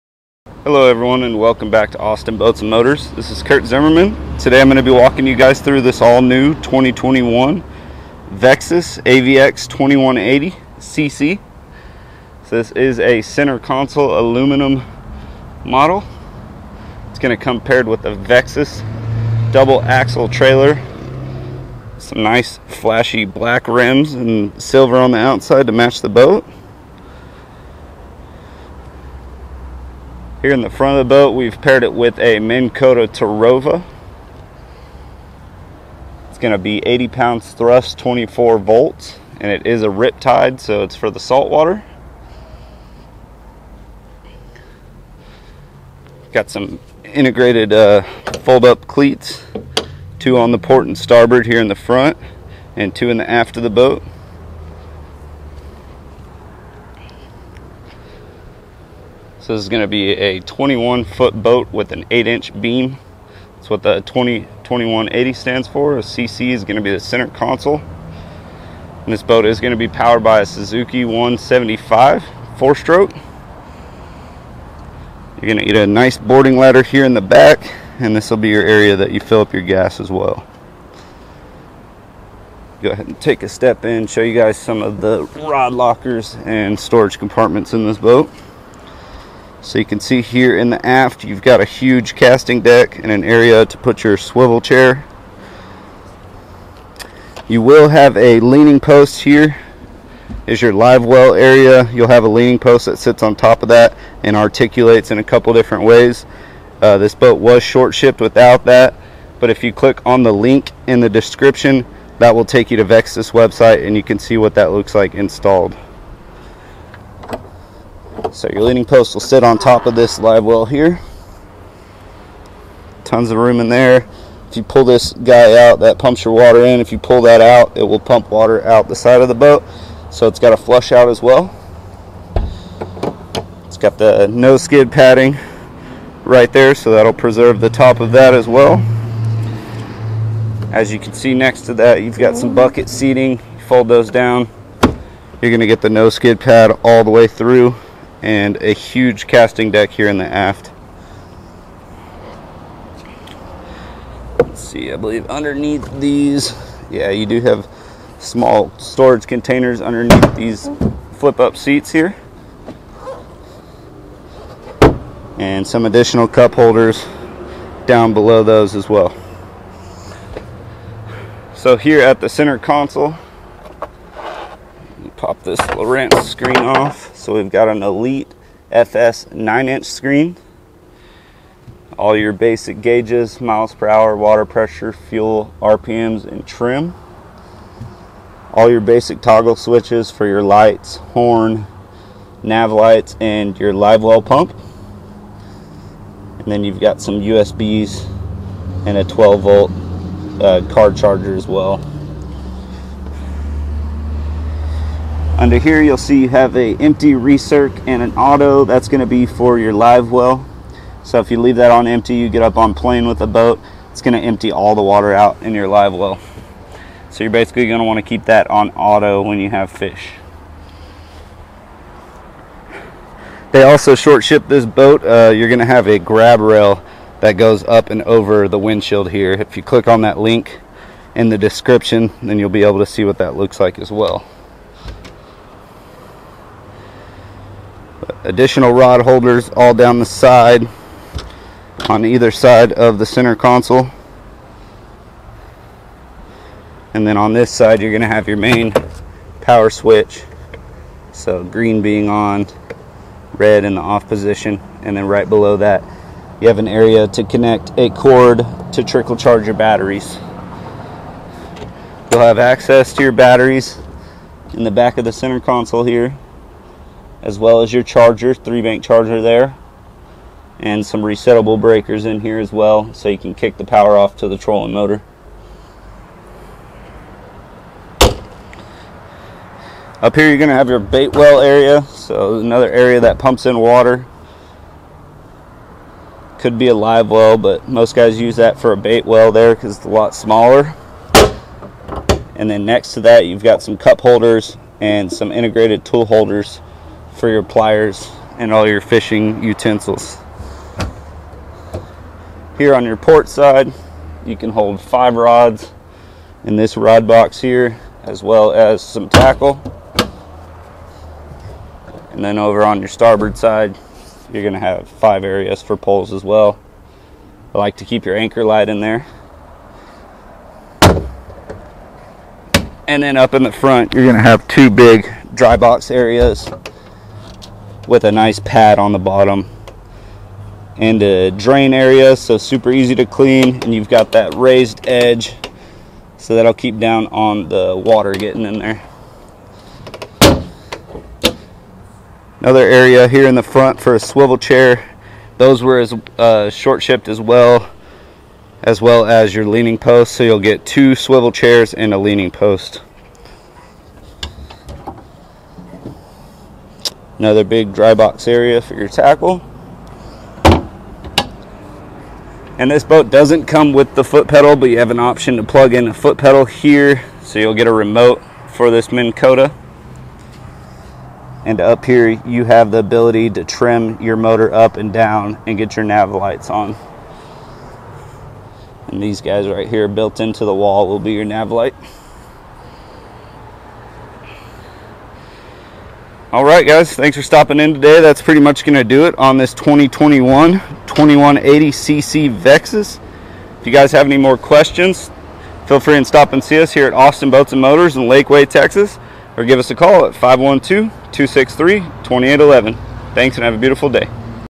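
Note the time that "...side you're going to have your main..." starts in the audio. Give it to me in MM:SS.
04:07.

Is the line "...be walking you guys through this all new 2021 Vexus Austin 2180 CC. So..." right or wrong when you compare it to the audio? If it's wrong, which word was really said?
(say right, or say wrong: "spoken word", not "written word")
wrong: "AVX", not "Austin".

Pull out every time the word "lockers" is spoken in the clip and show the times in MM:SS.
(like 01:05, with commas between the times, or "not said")
01:25.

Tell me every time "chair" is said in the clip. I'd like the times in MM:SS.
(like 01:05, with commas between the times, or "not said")
01:34, 05:44, 05:51.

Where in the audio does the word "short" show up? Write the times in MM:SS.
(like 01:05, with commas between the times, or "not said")
01:47, 03:43, 05:46.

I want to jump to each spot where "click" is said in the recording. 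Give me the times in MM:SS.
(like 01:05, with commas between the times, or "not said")
01:49, 03:49.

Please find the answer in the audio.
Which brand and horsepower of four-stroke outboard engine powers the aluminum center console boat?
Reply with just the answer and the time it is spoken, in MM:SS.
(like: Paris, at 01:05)
Suzuki 175, at 01:10.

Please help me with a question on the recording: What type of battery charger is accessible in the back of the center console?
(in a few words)
three bank charger.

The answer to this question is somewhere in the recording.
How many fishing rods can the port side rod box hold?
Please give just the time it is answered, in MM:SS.
05:04.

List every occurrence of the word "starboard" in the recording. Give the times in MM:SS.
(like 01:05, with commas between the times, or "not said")
00:50, 05:12.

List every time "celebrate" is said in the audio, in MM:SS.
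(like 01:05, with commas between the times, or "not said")
not said.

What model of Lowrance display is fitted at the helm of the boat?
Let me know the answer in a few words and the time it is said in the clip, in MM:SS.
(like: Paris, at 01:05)
Elite FS 9 inch, at 02:57.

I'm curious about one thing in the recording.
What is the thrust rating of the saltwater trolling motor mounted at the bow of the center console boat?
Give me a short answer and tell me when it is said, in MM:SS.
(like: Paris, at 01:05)
80 pounds, at 00:36.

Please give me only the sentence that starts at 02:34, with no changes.
Let's see, I believe underneath these, yeah, you do have small storage containers underneath these flip up seats here.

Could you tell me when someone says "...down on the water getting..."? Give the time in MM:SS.
05:36.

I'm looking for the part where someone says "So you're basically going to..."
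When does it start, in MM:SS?
03:37.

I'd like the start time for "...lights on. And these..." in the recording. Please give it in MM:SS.
06:16.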